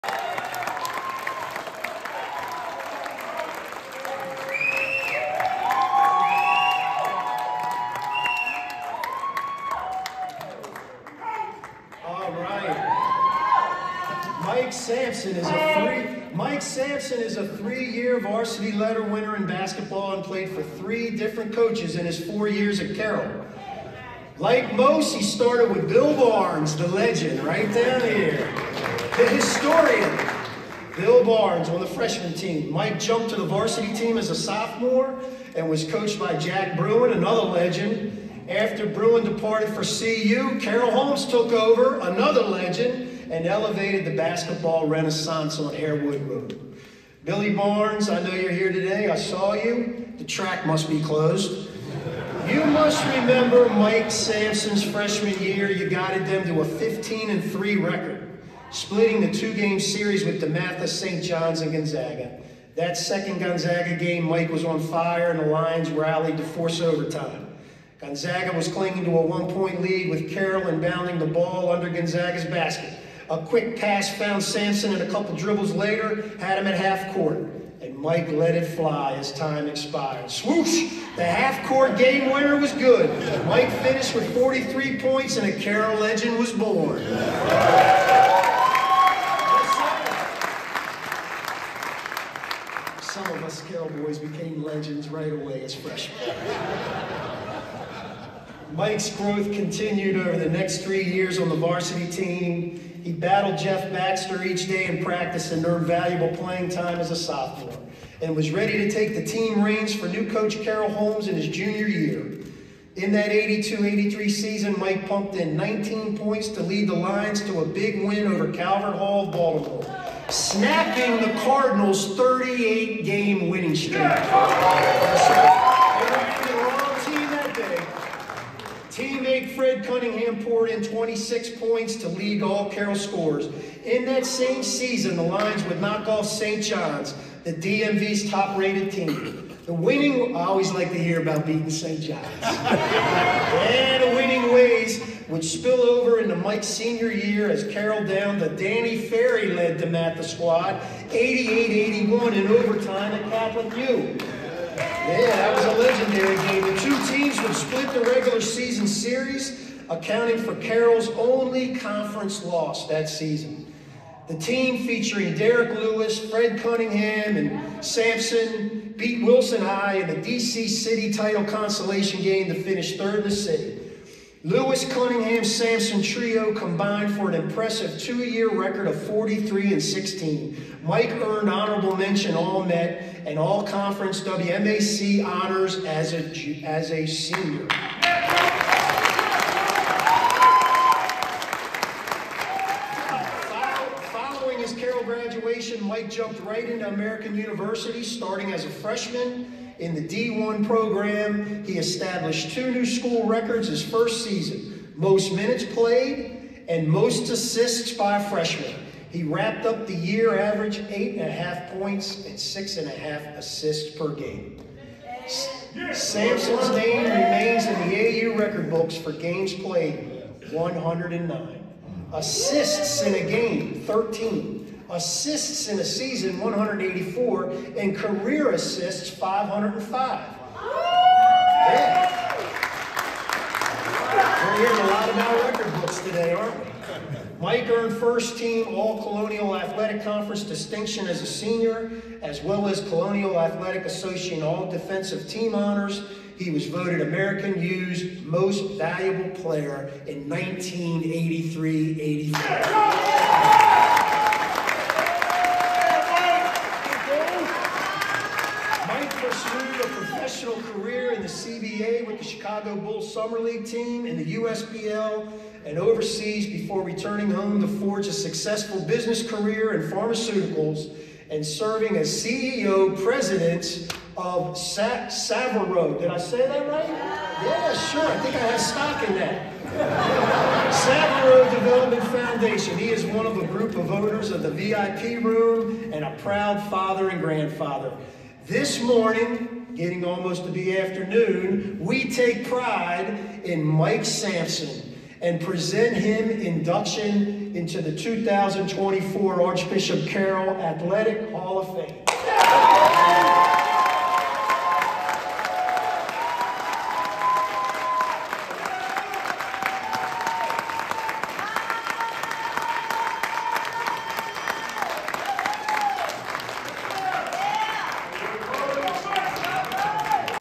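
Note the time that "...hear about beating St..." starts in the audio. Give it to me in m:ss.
2:21.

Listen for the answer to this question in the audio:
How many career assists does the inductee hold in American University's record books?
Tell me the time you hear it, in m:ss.
3:49.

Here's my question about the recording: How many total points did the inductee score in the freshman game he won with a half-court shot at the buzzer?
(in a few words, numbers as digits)
43.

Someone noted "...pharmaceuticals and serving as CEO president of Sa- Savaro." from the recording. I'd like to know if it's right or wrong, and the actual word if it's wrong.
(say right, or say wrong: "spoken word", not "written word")
right.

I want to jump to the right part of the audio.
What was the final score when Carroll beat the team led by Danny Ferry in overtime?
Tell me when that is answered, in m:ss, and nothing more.
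2:31.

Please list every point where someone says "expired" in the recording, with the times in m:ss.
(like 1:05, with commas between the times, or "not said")
1:19.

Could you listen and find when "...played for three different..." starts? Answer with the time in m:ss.
0:20.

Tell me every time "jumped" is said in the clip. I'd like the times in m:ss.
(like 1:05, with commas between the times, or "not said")
0:32, 3:16.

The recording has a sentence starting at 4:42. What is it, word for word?
He is one of a group of owners of the VIP room and a proud father and grandfather.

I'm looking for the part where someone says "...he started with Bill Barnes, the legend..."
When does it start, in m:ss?
0:25.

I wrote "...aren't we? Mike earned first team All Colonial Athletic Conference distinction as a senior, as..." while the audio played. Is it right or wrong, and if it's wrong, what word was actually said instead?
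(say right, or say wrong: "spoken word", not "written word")
right.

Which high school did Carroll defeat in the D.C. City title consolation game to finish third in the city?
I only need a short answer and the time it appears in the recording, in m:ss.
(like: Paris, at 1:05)
Wilson High, at 2:49.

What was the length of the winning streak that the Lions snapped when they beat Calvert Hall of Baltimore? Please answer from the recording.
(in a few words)
38 games.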